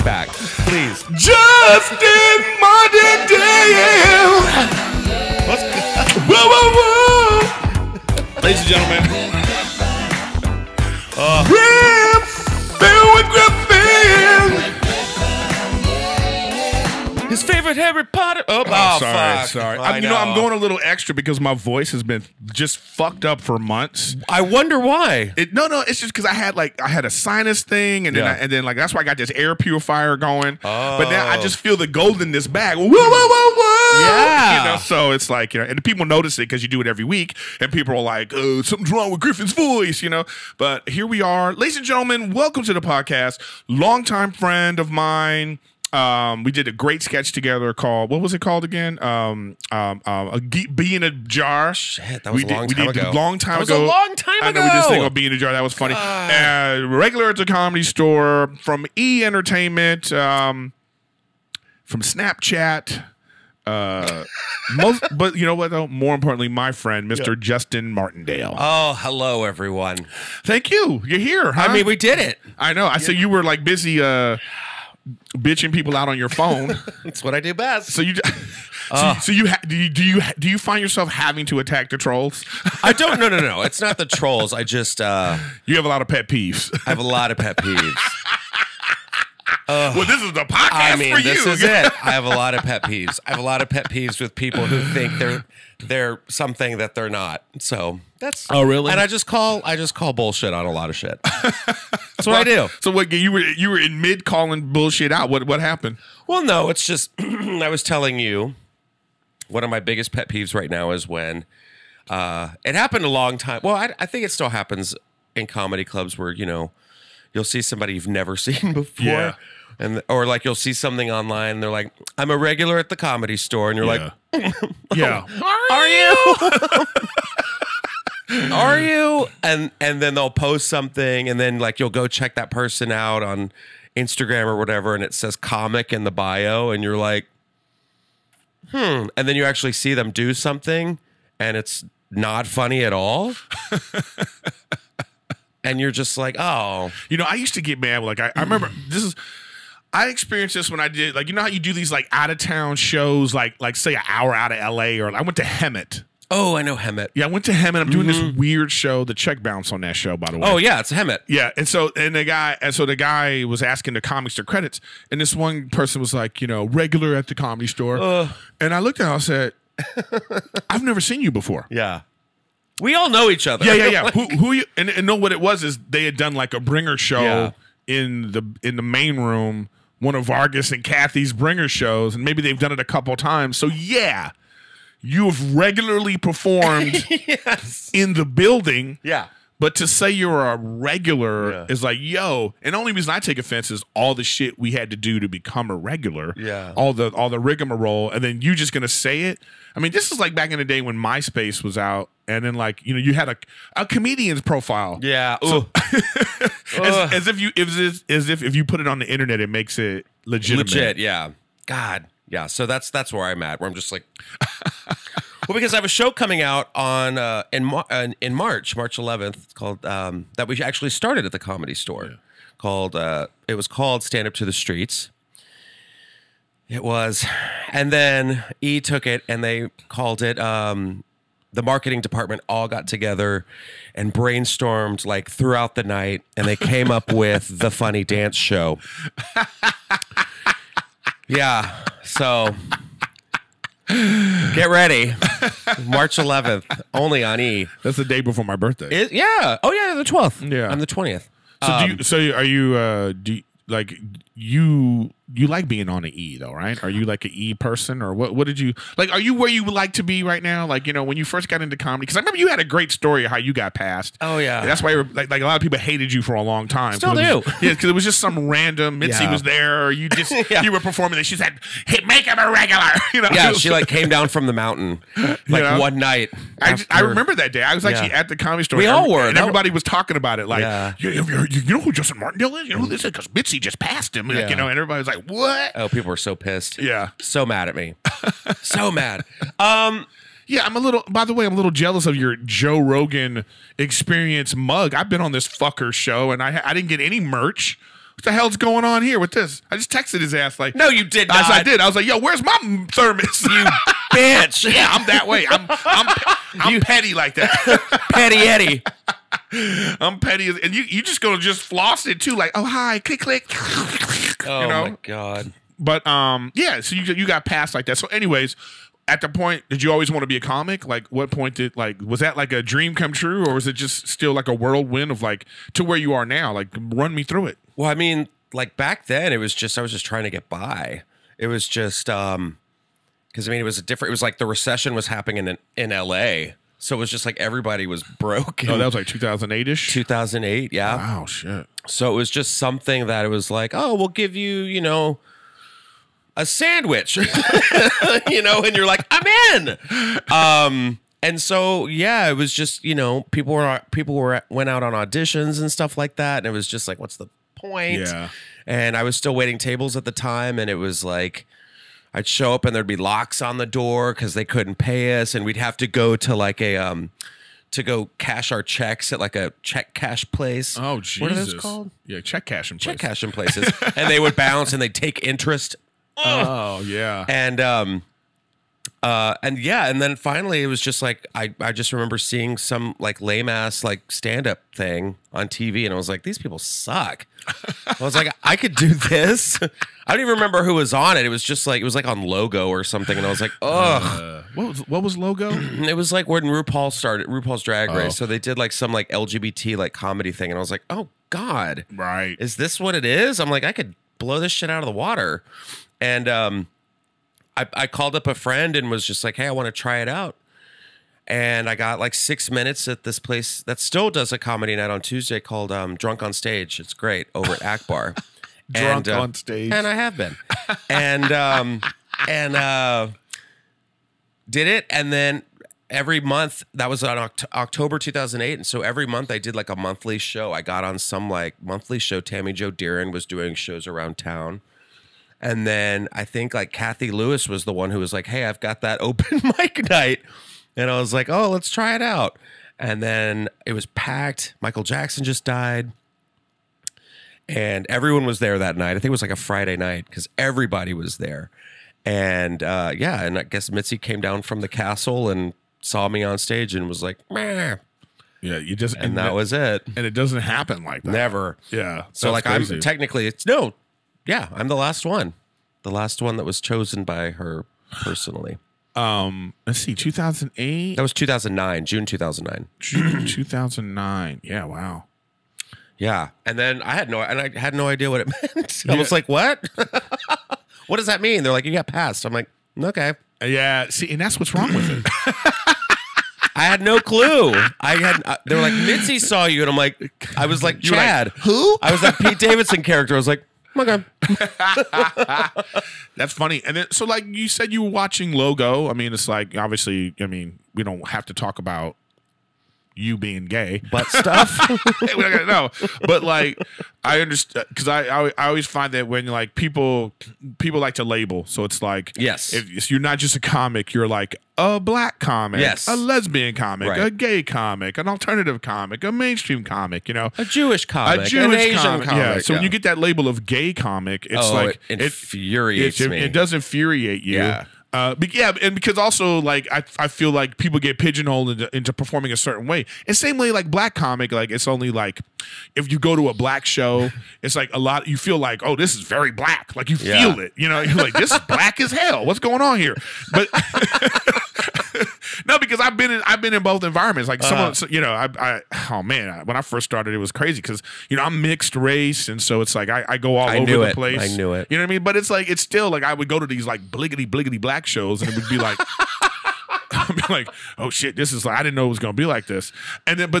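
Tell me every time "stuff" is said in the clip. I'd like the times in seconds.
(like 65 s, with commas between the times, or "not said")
355 s, 504 s.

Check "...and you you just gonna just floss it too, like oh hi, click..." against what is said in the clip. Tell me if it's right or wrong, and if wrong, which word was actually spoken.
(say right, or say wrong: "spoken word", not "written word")
right.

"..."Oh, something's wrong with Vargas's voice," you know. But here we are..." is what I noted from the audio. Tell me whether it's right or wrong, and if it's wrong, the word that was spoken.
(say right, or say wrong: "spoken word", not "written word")
wrong: "Griffin", not "Vargas".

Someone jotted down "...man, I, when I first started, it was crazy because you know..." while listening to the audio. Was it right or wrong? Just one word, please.
right.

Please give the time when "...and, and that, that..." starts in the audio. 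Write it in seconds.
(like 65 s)
458 s.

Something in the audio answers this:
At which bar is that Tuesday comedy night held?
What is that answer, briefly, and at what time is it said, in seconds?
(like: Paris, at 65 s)
Akbar, at 417 s.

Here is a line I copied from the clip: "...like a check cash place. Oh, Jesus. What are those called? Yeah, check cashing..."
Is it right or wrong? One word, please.
right.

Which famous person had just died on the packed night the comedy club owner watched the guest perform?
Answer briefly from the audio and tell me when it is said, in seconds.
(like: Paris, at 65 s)
Michael Jackson, at 444 s.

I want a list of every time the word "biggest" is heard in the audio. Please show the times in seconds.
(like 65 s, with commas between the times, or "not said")
109 s.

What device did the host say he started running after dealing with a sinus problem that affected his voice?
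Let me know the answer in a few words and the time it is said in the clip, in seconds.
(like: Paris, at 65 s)
Air purifier, at 29 s.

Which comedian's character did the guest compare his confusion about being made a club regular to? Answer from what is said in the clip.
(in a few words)
Pete Davidson.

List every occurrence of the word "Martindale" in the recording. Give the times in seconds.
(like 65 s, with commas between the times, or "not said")
67 s, 282 s.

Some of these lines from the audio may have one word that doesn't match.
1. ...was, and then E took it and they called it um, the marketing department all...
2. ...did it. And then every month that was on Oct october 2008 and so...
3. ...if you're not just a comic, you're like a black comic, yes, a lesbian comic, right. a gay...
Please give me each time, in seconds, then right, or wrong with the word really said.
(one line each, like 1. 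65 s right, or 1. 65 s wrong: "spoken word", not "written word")
1. 226 s right
2. 424 s right
3. 512 s right.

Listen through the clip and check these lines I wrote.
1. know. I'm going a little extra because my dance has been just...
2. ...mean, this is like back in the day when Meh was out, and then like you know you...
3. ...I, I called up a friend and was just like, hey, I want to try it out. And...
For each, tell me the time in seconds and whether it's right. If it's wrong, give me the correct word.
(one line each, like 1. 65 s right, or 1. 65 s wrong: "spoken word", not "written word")
1. 20 s wrong: "voice", not "dance"
2. 199 s wrong: "MySpace", not "Meh"
3. 407 s right.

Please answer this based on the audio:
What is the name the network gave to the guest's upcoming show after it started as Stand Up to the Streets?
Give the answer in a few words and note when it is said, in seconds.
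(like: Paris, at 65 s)
The Funny Dance Show, at 237 s.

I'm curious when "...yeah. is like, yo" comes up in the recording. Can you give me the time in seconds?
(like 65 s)
191 s.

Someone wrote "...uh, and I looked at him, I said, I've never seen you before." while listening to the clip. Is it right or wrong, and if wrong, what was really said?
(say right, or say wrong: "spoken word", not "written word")
right.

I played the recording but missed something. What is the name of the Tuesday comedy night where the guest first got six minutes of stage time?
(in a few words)
Drunk on Stage.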